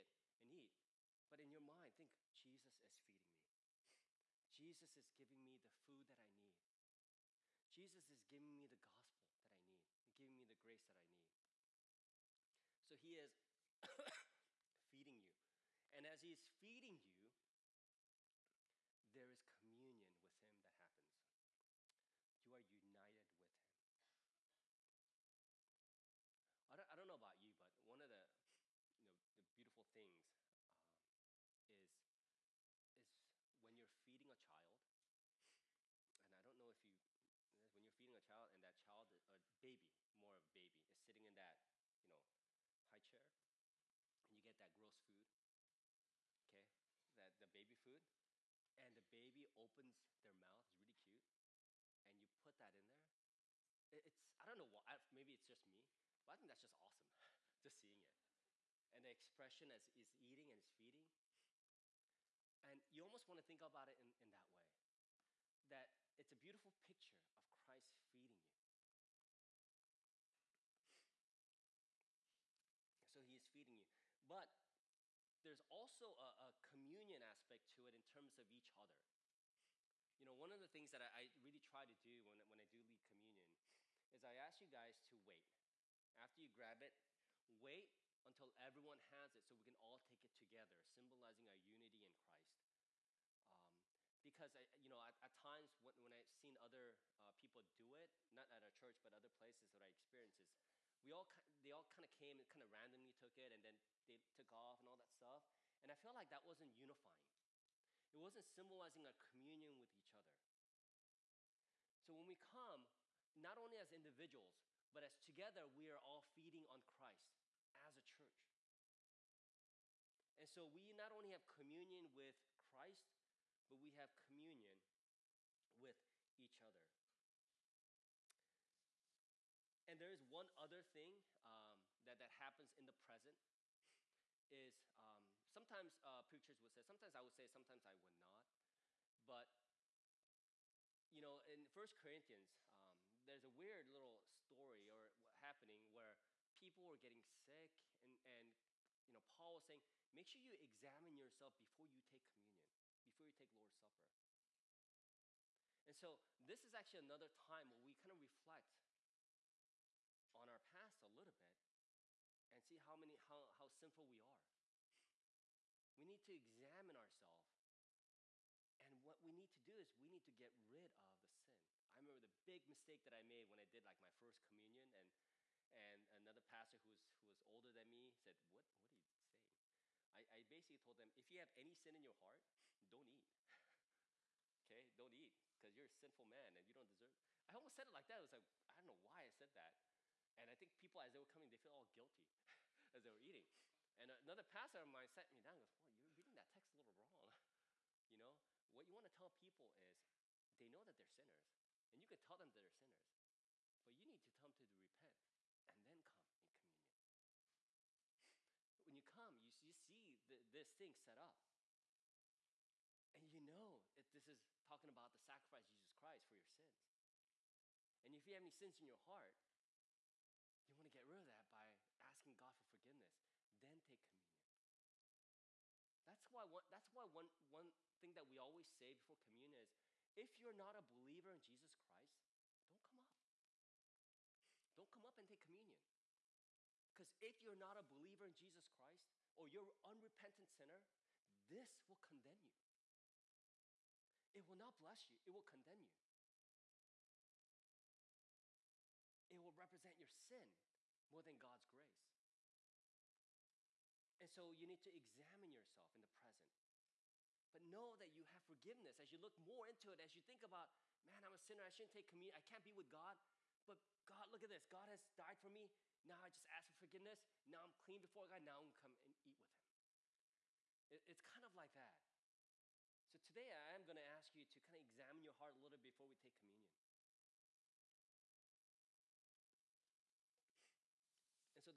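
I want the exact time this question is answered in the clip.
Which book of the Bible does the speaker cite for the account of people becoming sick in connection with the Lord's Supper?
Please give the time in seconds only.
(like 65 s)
141 s.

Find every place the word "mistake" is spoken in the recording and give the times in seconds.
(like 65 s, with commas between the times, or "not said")
172 s.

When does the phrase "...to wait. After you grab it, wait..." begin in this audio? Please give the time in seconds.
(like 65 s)
85 s.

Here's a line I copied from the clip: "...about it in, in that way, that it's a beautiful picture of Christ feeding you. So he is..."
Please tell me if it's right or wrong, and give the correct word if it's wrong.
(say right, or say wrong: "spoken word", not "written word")
right.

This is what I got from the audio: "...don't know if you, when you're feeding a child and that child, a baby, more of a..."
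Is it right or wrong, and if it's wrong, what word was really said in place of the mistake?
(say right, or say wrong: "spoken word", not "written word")
right.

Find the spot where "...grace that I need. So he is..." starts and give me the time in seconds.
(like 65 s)
10 s.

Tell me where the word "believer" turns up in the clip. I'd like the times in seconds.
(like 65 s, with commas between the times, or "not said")
230 s, 237 s.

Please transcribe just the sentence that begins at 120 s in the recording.
And so we not only have communion with Christ, but we have communion with each other.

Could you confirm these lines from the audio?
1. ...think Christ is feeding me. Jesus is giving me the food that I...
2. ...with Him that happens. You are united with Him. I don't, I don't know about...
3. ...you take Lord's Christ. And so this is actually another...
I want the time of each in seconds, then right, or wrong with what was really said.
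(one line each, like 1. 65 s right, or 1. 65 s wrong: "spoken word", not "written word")
1. 1 s wrong: "Jesus", not "Christ"
2. 20 s right
3. 153 s wrong: "Supper", not "Christ".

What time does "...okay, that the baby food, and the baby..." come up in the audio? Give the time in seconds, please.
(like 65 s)
46 s.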